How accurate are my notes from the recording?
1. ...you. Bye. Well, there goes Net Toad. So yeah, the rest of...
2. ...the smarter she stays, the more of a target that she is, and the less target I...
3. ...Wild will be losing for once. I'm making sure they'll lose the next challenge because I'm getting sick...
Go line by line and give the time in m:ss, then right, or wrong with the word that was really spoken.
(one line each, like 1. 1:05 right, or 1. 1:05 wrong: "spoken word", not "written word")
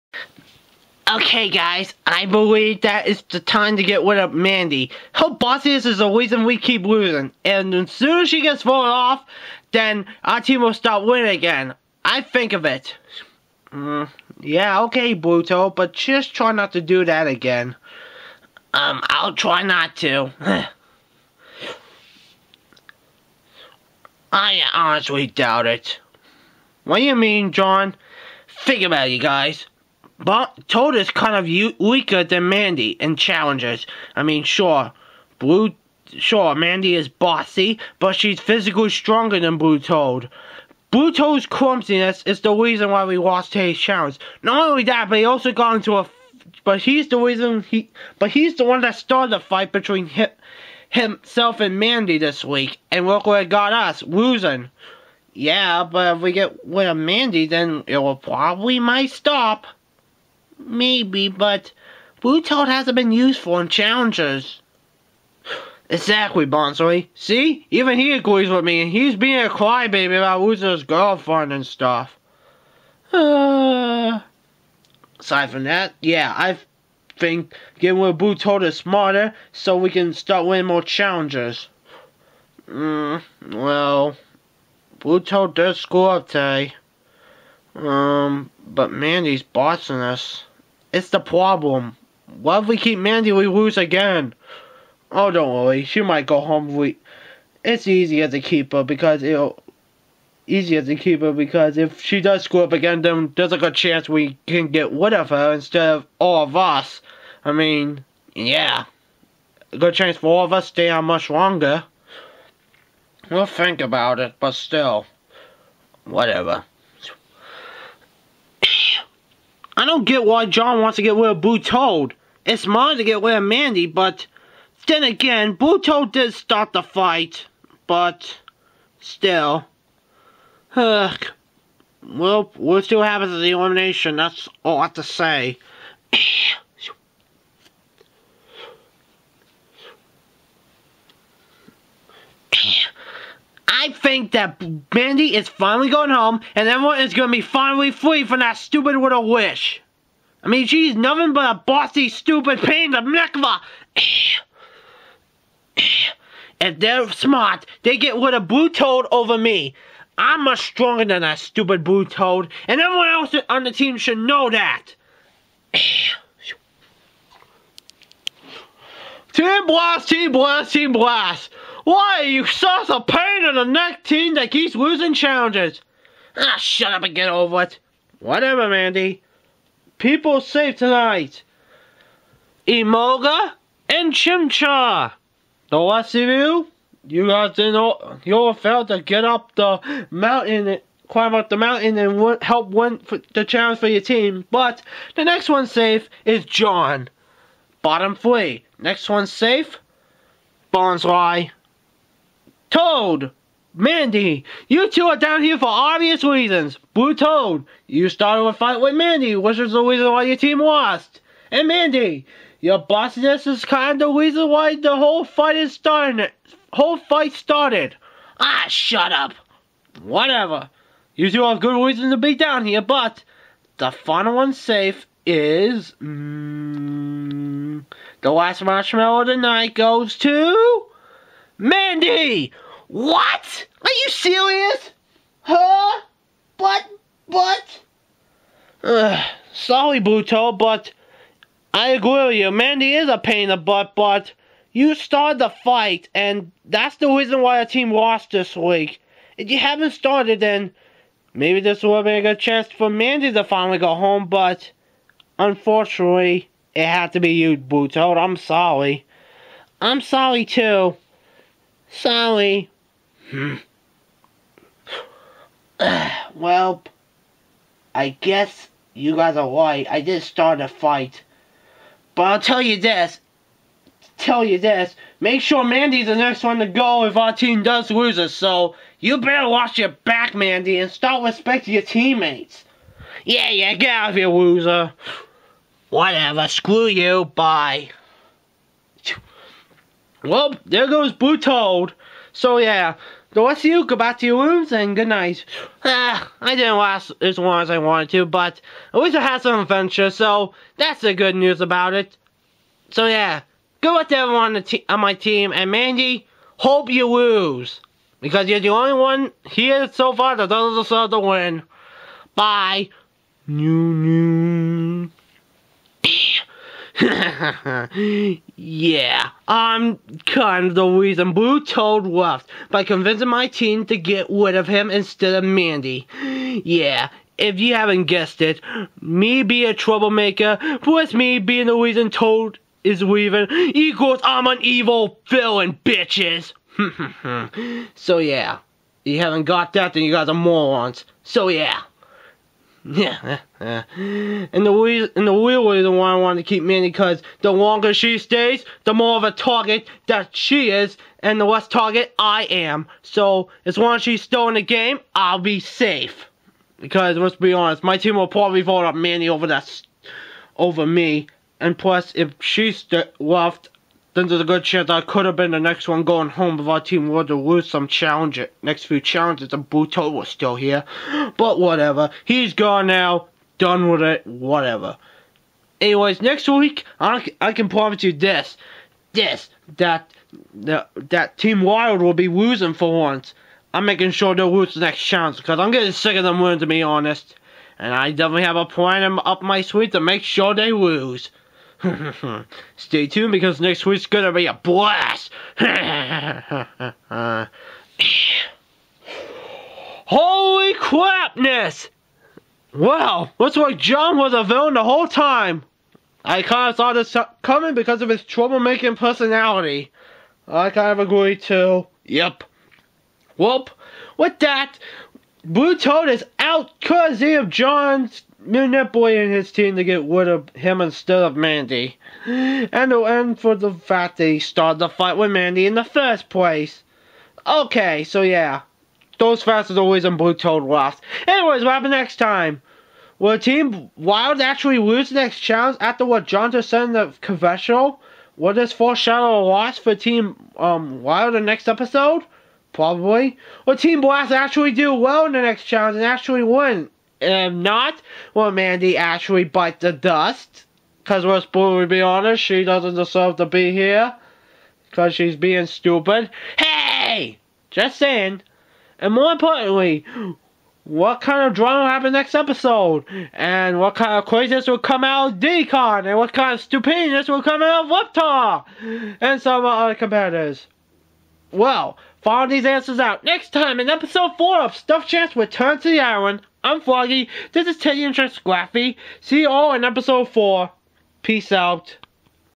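1. 4:46 wrong: "Blue", not "Net"
2. 5:47 wrong: "longer", not "smarter"
3. 6:21 right.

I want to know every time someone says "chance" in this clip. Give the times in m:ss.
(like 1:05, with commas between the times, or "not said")
1:43, 1:49, 4:12, 6:04.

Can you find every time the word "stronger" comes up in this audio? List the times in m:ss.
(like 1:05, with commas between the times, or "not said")
0:38, 2:40.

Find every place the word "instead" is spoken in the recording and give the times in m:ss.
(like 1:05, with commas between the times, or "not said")
1:45, 5:24, 7:00.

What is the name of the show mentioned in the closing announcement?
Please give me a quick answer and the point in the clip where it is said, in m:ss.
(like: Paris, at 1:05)
Stuffed Champs Return to the Island, at 7:54.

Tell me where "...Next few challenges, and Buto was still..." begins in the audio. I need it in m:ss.
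6:08.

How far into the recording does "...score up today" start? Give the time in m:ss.
1:25.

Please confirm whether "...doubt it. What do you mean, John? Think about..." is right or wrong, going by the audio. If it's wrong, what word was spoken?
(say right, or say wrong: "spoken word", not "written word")
right.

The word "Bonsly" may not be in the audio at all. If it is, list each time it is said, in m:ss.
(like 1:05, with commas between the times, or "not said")
1:06, 3:20.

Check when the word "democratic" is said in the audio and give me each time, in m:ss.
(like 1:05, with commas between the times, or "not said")
not said.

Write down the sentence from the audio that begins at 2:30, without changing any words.
I mean, she's nothing but a bossy, stupid pain in the a...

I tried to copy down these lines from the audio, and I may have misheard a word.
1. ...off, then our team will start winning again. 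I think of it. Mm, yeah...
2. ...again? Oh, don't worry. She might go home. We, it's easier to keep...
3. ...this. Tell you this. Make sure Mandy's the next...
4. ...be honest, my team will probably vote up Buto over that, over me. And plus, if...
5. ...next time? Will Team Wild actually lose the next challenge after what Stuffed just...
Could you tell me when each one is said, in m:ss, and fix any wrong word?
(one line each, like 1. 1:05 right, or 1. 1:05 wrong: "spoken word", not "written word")
1. 0:08 right
2. 1:33 right
3. 4:32 right
4. 5:57 wrong: "Mandy", not "Buto"
5. 7:11 wrong: "John", not "Stuffed".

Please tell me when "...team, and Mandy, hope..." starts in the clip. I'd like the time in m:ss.
5:05.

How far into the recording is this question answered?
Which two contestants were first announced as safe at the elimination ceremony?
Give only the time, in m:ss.
3:02.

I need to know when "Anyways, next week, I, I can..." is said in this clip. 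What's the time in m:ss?
6:15.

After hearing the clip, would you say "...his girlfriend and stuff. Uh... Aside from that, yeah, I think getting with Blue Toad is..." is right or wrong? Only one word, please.
right.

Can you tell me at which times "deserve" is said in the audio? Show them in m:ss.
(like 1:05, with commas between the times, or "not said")
5:10, 7:32.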